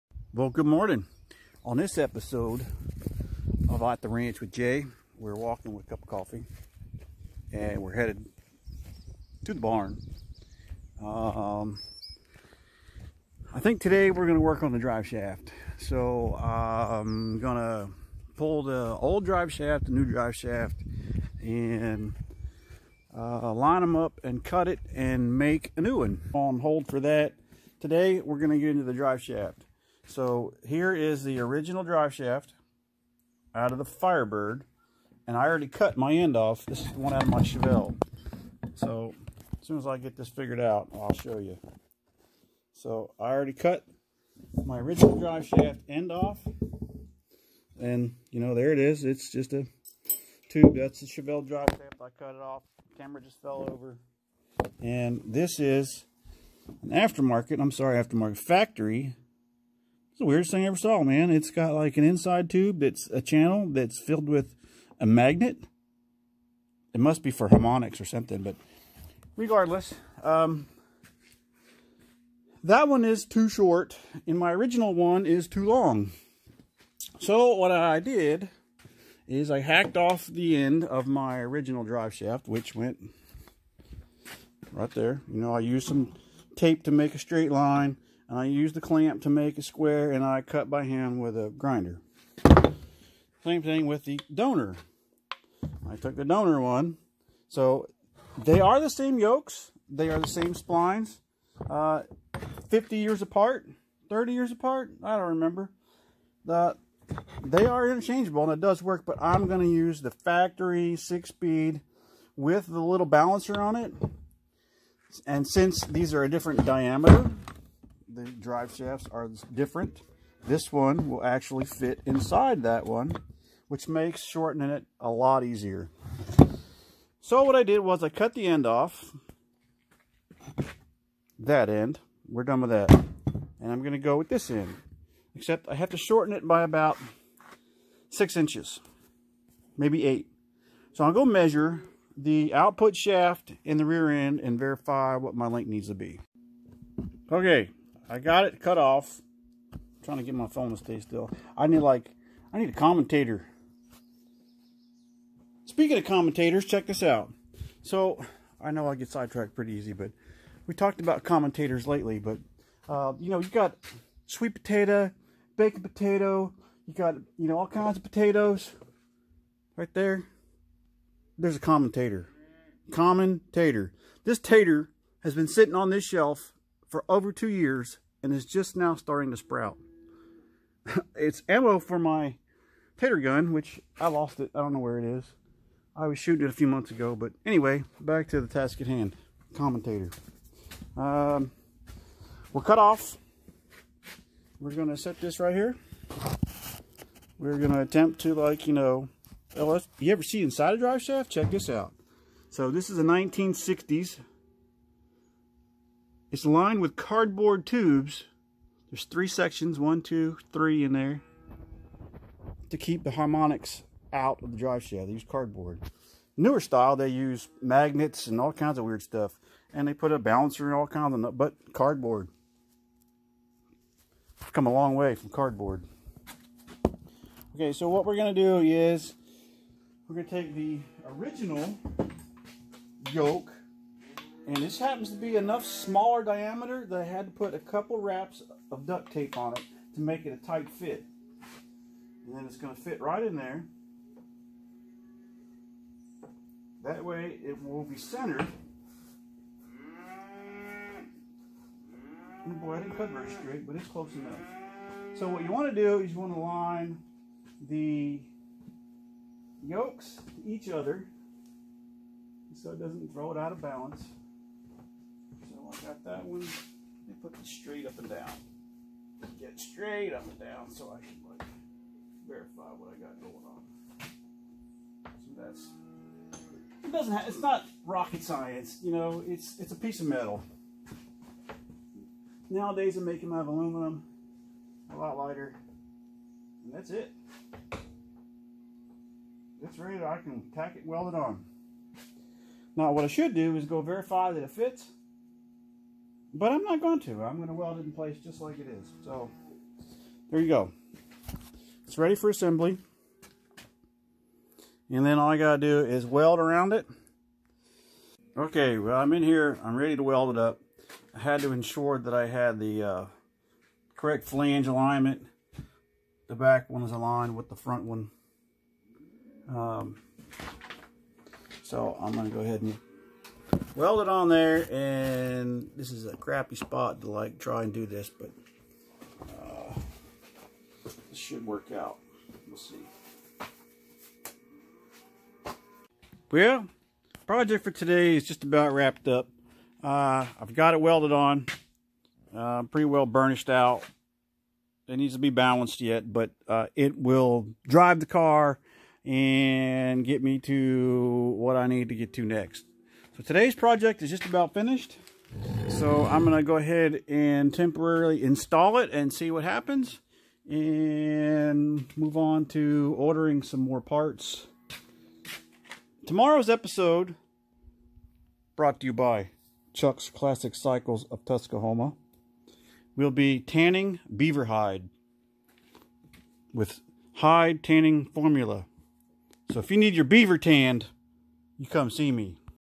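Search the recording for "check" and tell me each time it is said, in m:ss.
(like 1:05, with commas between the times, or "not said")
2:36, 3:21.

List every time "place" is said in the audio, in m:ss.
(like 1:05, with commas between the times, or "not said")
4:57.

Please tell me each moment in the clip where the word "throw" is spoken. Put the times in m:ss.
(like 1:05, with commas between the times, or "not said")
4:23.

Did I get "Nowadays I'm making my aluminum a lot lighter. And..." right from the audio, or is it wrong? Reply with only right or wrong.
right.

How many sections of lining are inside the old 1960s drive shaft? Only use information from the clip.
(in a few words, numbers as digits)
3.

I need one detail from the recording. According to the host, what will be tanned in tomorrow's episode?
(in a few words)
beaver hide.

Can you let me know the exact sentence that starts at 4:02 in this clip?
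And then it's going to fit right in there.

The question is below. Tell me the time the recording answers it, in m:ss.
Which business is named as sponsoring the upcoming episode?
6:09.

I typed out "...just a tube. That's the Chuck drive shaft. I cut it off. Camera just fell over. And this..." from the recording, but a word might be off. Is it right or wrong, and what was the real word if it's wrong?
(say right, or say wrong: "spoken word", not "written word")
wrong: "Chevelle", not "Chuck".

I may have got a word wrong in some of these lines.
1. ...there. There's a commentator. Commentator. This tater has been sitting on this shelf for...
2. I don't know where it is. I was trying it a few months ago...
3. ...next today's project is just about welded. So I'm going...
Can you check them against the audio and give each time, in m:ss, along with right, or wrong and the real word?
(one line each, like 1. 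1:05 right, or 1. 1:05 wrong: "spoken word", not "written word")
1. 2:49 right
2. 3:04 wrong: "shooting", not "trying"
3. 5:52 wrong: "finished", not "welded".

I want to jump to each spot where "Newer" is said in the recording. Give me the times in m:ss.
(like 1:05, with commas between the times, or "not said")
3:36.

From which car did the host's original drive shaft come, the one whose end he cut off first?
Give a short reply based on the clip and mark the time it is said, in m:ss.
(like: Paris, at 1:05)
Firebird, at 0:33.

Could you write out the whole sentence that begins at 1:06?
It must be for harmonics or something, but regardless, um, that one is too short, and my original one is too long.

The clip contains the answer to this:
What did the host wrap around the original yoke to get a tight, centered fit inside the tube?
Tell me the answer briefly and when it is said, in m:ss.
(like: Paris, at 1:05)
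duct tape, at 3:58.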